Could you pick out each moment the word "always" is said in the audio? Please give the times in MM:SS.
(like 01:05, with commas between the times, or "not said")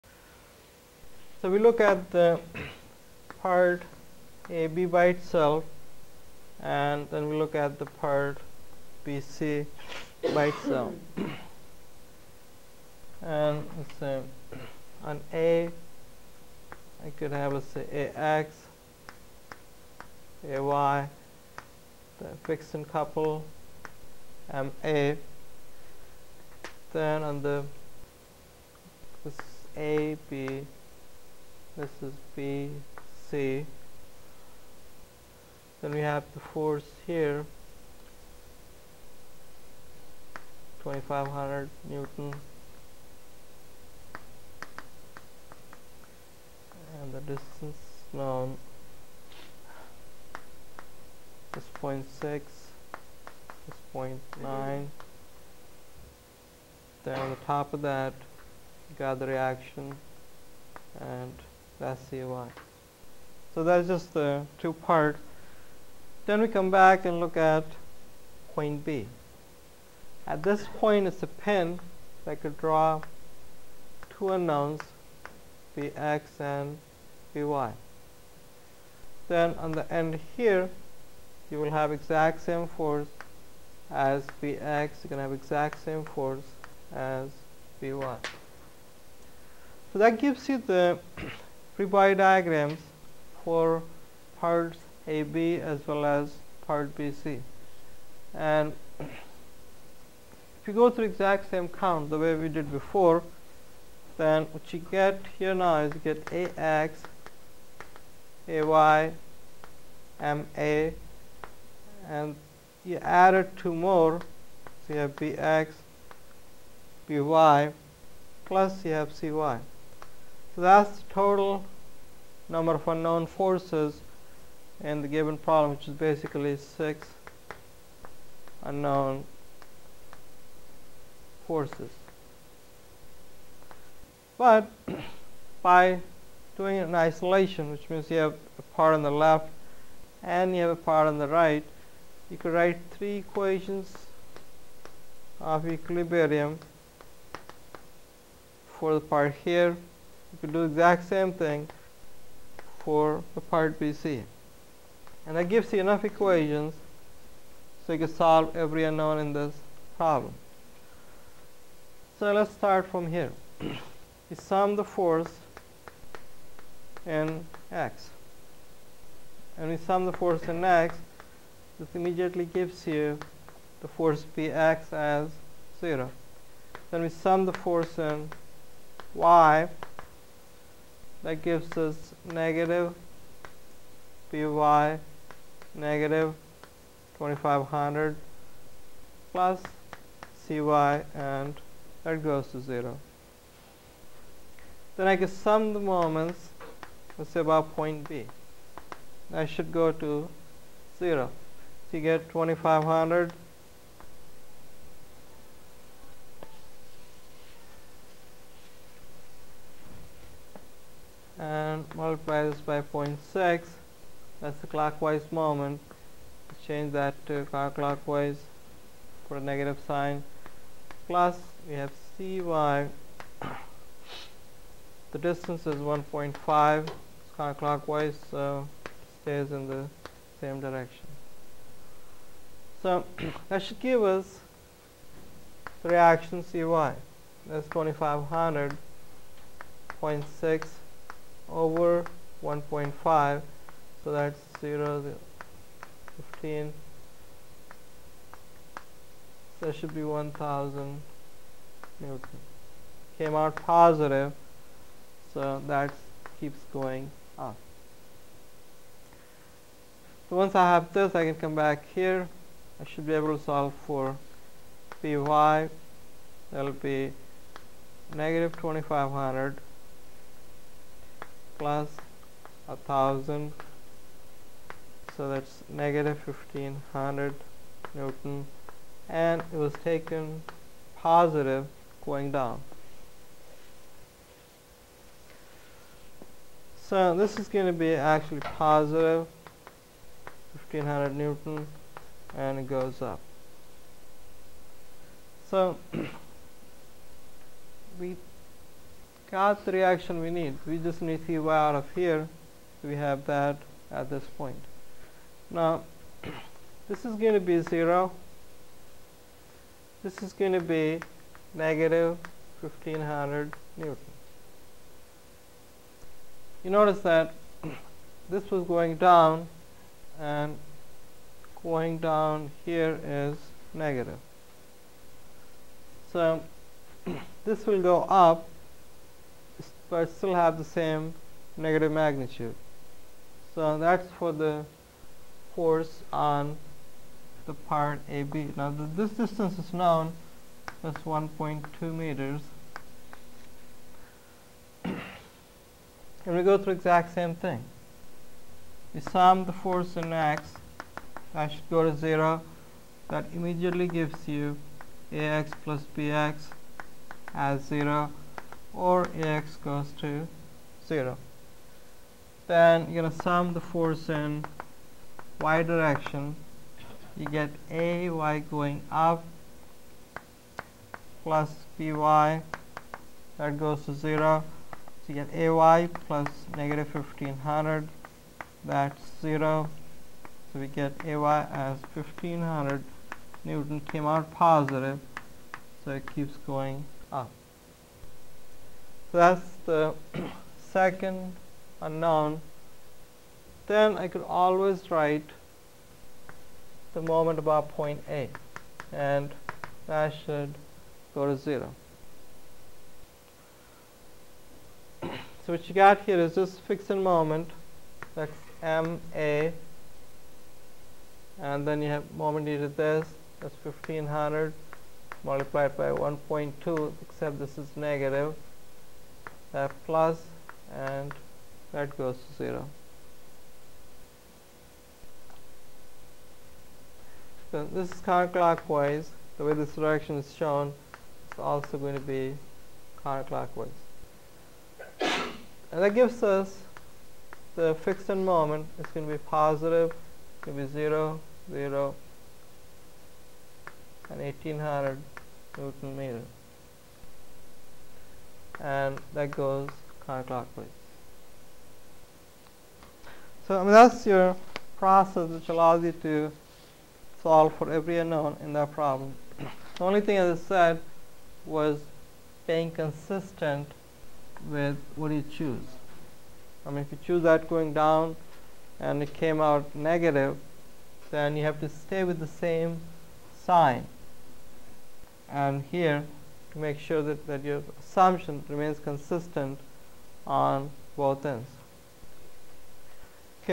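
06:34.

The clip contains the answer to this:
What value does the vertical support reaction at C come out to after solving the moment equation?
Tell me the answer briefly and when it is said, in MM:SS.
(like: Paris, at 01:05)
1000 N, at 04:10.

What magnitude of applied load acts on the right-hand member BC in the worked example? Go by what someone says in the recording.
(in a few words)
2500 N.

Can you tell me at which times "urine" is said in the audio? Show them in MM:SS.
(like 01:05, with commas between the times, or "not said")
not said.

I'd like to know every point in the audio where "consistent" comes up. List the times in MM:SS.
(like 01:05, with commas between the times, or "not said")
07:42, 07:58.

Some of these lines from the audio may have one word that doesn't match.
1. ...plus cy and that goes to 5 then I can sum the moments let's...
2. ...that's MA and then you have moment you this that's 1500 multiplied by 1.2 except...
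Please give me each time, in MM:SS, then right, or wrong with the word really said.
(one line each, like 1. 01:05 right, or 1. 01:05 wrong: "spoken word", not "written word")
1. 03:09 wrong: "0", not "5"
2. 06:48 right.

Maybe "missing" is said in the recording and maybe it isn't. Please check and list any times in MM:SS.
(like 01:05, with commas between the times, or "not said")
not said.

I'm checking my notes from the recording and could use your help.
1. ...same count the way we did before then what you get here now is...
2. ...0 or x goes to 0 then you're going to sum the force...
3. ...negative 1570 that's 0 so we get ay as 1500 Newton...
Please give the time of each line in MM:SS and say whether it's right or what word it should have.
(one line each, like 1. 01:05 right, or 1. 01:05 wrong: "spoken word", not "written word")
1. 01:41 right
2. 05:57 right
3. 06:16 wrong: "1500", not "1570".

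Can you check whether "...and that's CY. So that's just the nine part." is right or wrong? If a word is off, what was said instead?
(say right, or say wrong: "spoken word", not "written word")
wrong: "two", not "nine".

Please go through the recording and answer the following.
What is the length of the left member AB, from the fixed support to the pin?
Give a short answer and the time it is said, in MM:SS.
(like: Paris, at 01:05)
1.2 meters, at 05:41.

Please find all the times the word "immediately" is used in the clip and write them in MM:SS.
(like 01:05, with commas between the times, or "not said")
02:51, 05:53.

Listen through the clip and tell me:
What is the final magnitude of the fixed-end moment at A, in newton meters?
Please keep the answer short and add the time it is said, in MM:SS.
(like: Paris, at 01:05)
1800, at 07:24.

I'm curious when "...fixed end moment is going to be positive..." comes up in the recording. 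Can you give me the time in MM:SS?
07:17.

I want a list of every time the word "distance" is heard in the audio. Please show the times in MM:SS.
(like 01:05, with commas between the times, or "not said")
00:47, 03:45, 05:39.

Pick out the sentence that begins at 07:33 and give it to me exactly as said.
So I mean, that's your process which allows you to solve for every unknown in that problem.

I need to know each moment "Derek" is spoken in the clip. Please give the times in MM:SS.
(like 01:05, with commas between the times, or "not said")
not said.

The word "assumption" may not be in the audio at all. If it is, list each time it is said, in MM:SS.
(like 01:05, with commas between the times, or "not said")
07:57.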